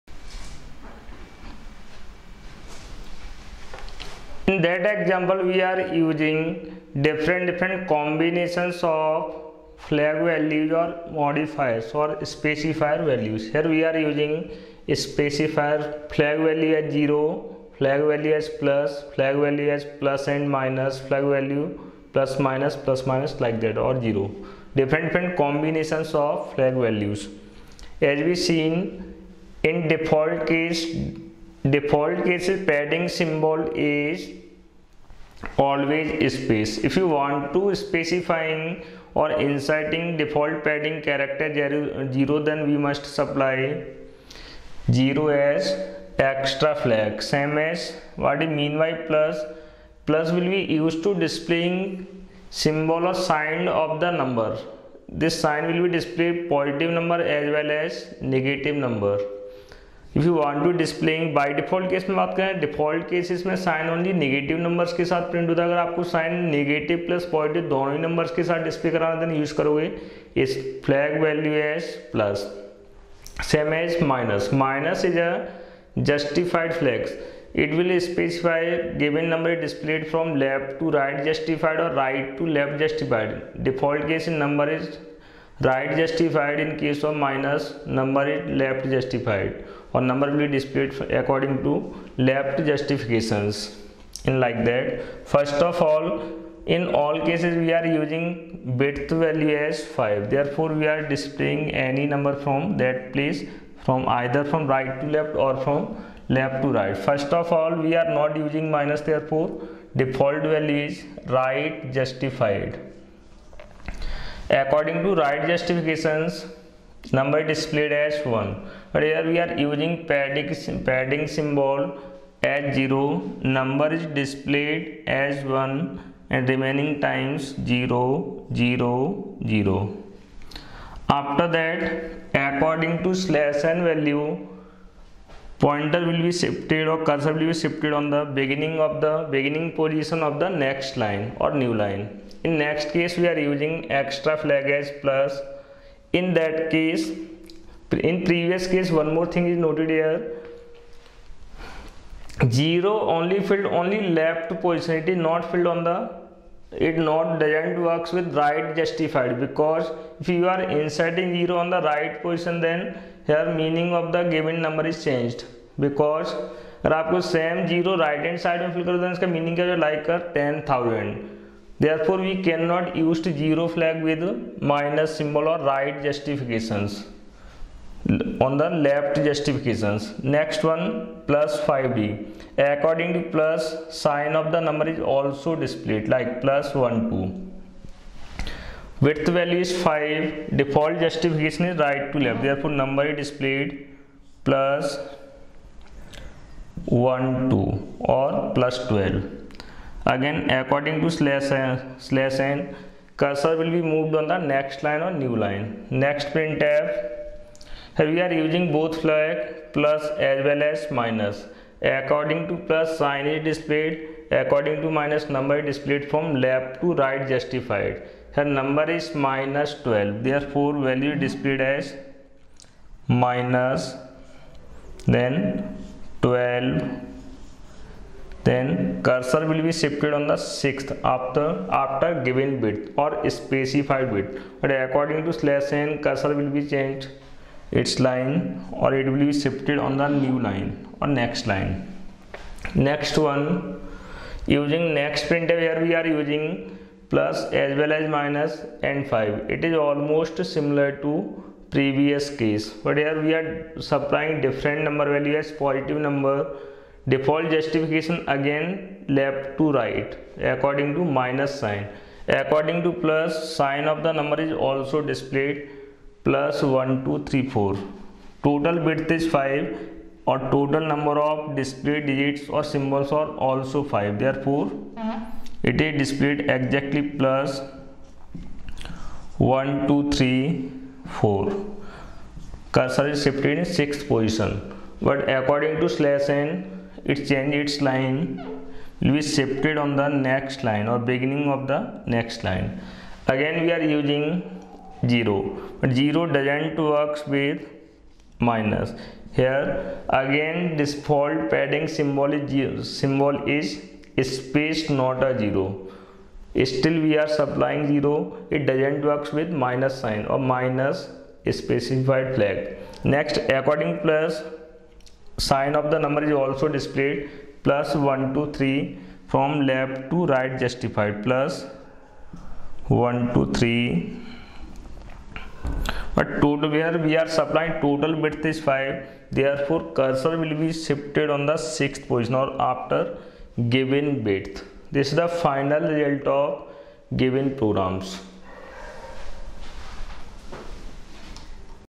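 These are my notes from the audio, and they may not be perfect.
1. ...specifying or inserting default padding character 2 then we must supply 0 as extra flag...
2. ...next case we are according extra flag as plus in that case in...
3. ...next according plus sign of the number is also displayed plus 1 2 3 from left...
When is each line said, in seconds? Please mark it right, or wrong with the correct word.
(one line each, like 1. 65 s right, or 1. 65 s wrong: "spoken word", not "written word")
1. 37 s wrong: "0", not "2"
2. 142 s wrong: "using", not "according"
3. 313 s right.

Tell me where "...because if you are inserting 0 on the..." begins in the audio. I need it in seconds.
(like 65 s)
159 s.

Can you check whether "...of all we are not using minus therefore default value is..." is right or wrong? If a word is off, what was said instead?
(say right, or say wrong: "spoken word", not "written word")
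right.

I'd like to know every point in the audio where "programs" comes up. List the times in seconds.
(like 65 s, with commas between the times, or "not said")
337 s.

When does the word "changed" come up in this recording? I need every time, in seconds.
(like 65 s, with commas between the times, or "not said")
165 s, 236 s.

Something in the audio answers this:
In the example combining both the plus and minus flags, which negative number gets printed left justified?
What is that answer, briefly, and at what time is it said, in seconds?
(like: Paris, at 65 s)
-12, at 219 s.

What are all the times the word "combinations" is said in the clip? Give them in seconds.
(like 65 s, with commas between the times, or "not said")
7 s, 25 s.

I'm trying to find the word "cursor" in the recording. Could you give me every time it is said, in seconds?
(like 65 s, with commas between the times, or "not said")
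137 s, 203 s, 229 s, 236 s, 329 s.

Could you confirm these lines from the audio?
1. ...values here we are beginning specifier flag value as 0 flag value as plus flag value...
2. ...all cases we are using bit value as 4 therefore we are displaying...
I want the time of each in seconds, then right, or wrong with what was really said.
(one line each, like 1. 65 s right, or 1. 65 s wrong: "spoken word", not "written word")
1. 13 s wrong: "using", not "beginning"
2. 97 s wrong: "5", not "4".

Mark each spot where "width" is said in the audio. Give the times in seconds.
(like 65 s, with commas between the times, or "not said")
189 s, 328 s, 334 s.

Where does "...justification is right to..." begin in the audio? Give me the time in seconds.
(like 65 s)
191 s.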